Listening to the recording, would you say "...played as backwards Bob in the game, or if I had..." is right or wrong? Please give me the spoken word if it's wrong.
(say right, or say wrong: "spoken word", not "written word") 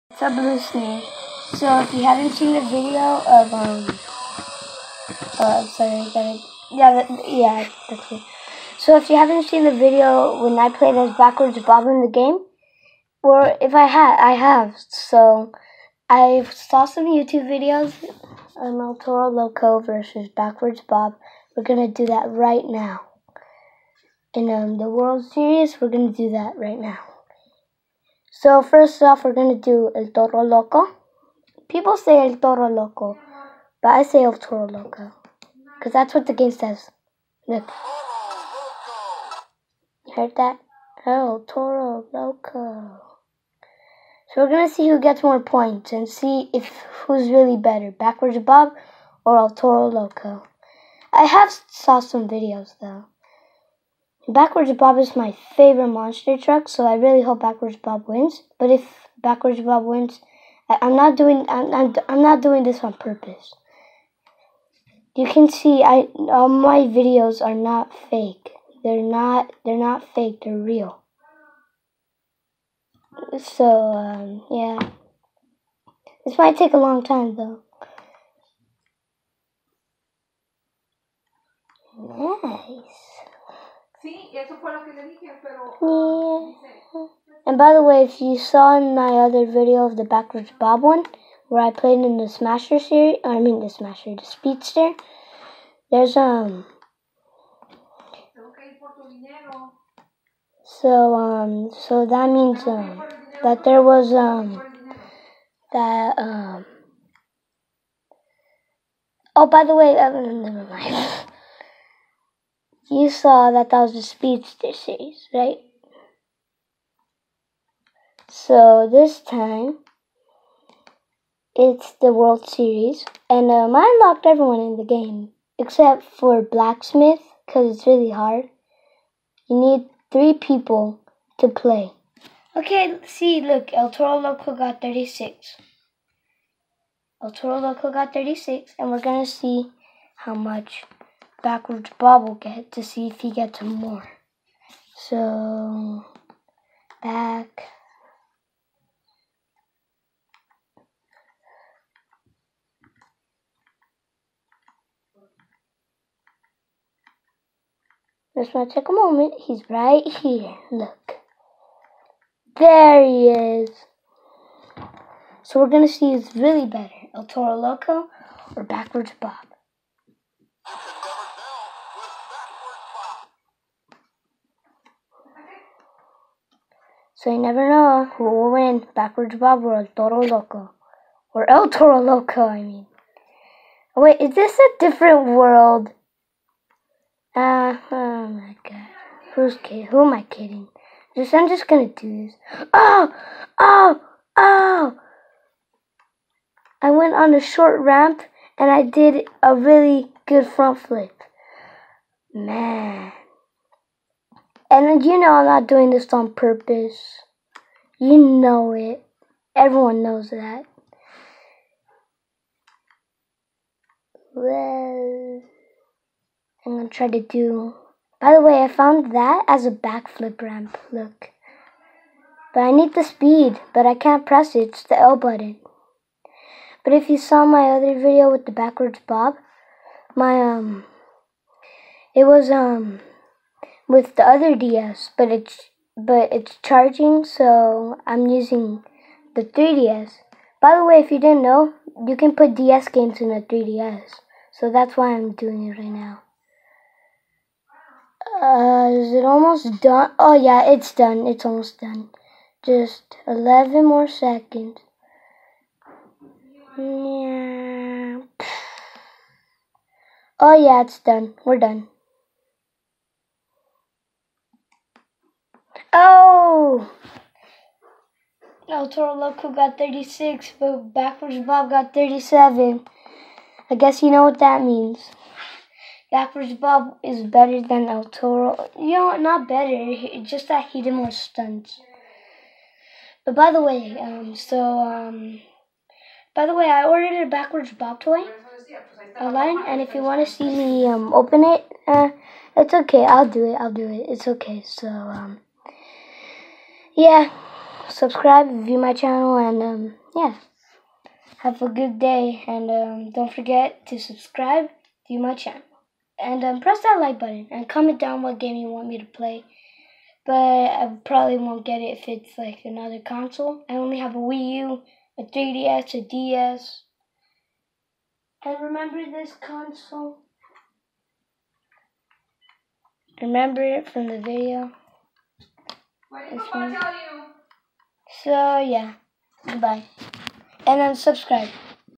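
right.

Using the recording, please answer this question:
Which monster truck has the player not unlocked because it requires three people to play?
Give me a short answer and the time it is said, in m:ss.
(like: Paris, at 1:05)
Blacksmith, at 2:06.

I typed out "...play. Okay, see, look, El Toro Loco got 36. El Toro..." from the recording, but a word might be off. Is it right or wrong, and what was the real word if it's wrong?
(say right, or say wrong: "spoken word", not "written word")
right.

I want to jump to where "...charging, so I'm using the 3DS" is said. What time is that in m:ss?
3:56.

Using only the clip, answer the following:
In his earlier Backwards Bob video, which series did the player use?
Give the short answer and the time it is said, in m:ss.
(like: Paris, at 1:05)
Speedster series, at 1:54.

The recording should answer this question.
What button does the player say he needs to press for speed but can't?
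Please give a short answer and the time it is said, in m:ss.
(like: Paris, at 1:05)
L button, at 3:44.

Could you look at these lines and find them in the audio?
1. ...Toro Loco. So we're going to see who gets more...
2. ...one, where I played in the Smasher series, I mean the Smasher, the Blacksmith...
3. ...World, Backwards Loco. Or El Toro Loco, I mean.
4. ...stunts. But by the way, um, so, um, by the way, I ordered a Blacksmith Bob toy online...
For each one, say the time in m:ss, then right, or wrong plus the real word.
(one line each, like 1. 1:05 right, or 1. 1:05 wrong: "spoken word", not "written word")
1. 0:41 right
2. 1:30 wrong: "Speedster", not "Blacksmith"
3. 2:59 wrong: "Toro", not "Backwards"
4. 4:41 wrong: "Backwards", not "Blacksmith".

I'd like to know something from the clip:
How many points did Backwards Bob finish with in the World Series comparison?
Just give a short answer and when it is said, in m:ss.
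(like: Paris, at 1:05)
37, at 4:31.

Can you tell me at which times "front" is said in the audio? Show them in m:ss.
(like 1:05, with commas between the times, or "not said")
3:20.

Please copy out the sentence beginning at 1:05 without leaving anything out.
You can see I all my videos are not fake.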